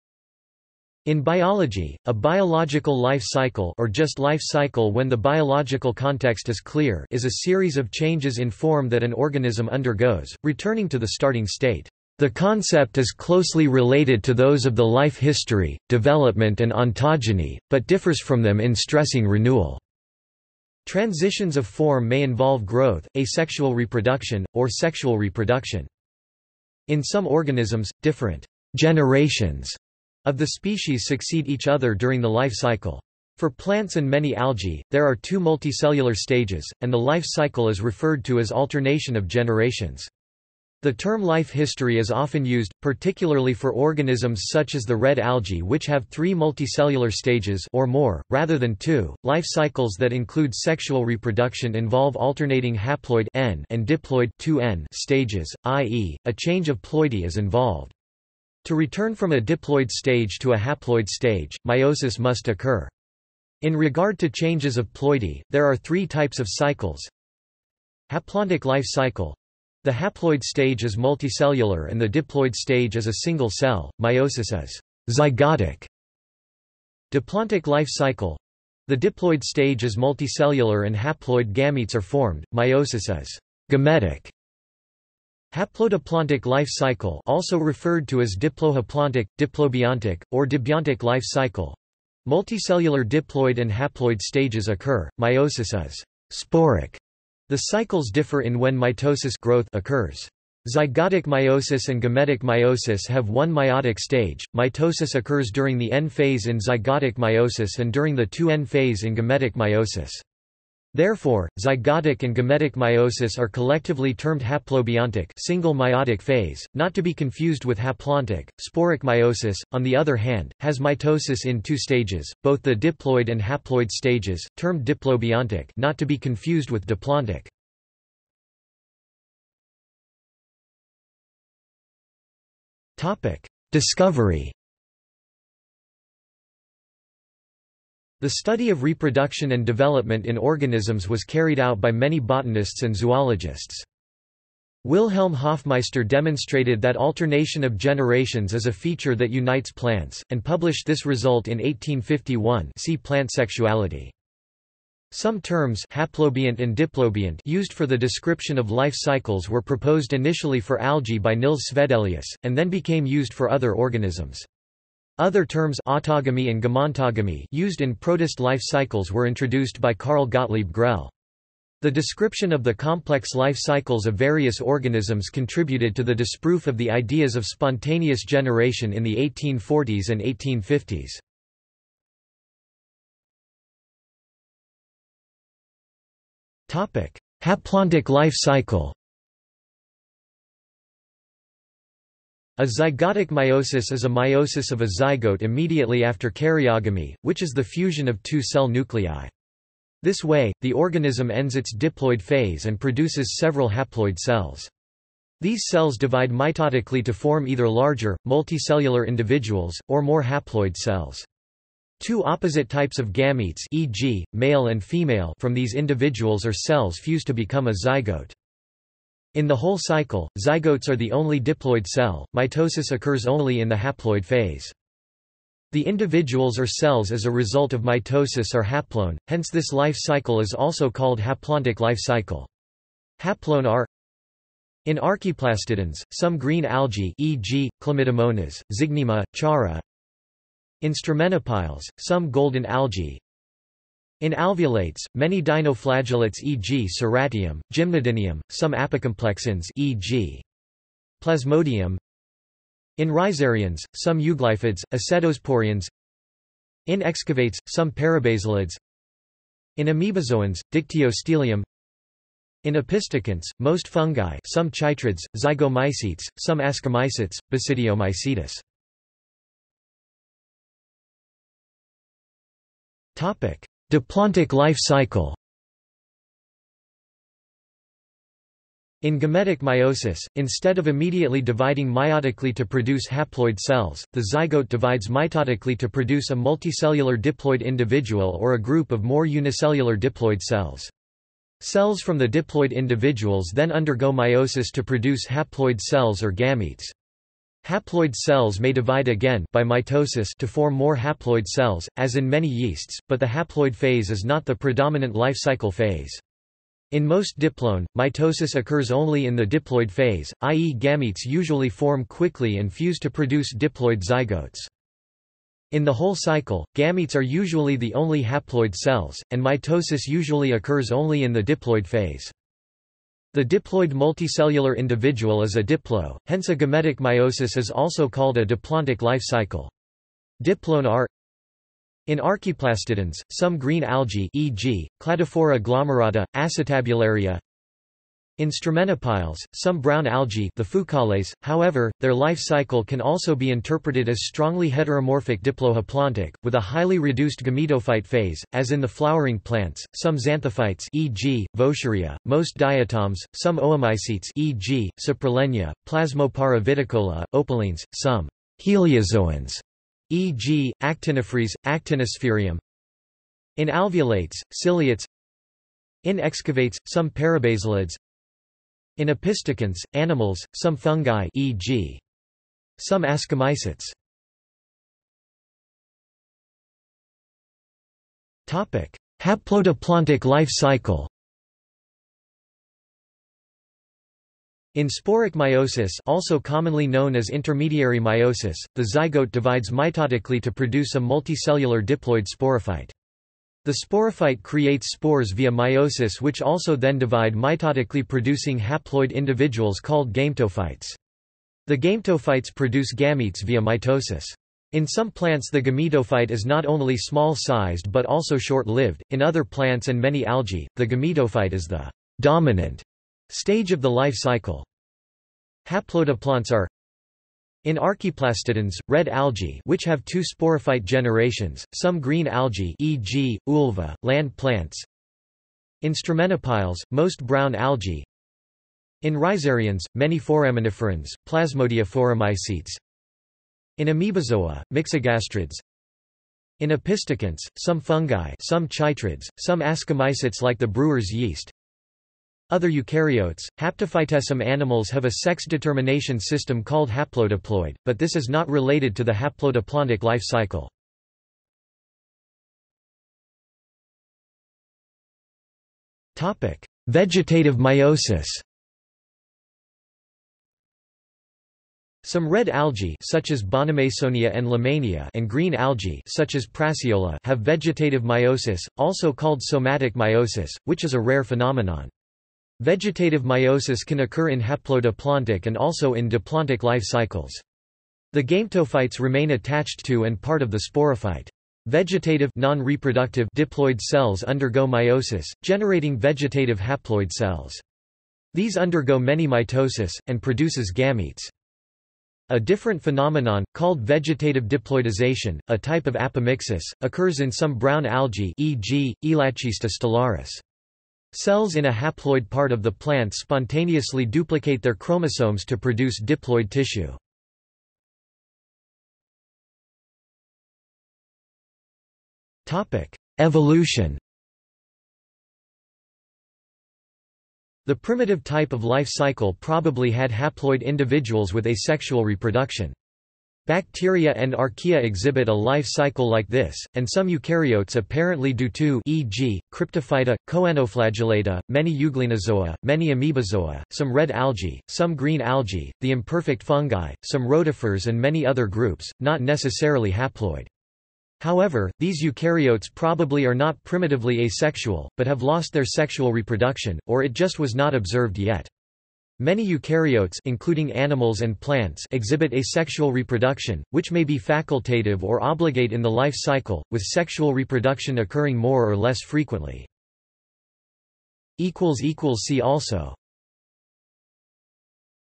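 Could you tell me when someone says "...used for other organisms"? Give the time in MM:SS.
02:43.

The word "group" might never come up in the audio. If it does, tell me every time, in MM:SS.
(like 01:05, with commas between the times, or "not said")
04:48, 08:58.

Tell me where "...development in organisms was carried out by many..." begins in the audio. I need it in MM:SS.
02:19.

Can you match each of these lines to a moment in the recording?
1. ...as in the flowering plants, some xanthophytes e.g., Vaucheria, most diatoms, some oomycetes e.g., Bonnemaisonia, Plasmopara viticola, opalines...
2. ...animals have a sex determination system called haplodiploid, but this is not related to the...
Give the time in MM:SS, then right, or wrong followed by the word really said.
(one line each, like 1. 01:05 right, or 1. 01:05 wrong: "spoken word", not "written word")
1. 05:48 wrong: "Saprolegnia", not "Bonnemaisonia"
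2. 07:24 right.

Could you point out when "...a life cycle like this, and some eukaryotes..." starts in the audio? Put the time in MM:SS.
08:45.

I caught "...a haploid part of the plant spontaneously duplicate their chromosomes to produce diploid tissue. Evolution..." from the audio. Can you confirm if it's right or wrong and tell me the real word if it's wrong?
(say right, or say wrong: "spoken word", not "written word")
right.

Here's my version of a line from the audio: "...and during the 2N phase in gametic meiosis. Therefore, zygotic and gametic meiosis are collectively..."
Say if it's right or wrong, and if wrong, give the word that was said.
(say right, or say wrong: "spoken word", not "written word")
right.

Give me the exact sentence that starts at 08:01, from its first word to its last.
Vegetative non-reproductive diploid cells undergo meiosis, generating vegetative haploid cells.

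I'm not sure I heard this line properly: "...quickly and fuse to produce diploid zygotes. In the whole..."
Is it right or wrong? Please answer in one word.
right.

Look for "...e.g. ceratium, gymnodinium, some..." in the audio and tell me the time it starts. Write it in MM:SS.
04:06.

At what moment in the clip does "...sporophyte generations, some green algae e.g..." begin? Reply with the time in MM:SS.
07:00.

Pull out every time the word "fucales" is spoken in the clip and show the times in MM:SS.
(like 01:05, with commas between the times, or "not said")
05:40.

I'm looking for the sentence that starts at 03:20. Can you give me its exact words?
This way, the organism ends its diploid phase and produces several haploid cells.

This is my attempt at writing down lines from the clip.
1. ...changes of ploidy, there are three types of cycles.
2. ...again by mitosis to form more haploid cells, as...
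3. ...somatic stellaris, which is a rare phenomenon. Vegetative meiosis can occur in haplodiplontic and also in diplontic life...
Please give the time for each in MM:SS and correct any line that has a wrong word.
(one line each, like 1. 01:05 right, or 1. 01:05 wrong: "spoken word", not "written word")
1. 01:04 right
2. 04:59 right
3. 07:49 wrong: "meiosis", not "stellaris".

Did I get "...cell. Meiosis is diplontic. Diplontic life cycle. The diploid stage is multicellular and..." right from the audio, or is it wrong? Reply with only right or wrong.
wrong.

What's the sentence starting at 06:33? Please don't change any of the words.
The sporophyte creates spores via meiosis which also then divide mitotically producing haploid individuals called gametophytes.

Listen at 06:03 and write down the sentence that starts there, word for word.
In alveolates, ciliates In excavates, some parabasalids in opisthokonts, animals, some fungi e.g.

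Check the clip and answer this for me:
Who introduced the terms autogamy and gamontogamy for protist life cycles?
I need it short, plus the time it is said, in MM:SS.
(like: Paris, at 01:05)
Carl Gottlieb Grell, at 02:49.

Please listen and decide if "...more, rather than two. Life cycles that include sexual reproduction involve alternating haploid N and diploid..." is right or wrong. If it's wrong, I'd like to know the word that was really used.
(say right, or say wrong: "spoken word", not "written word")
right.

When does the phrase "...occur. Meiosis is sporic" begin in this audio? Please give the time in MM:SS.
01:34.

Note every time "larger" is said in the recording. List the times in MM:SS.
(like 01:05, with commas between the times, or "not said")
03:27.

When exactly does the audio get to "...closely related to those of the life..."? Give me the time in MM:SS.
00:13.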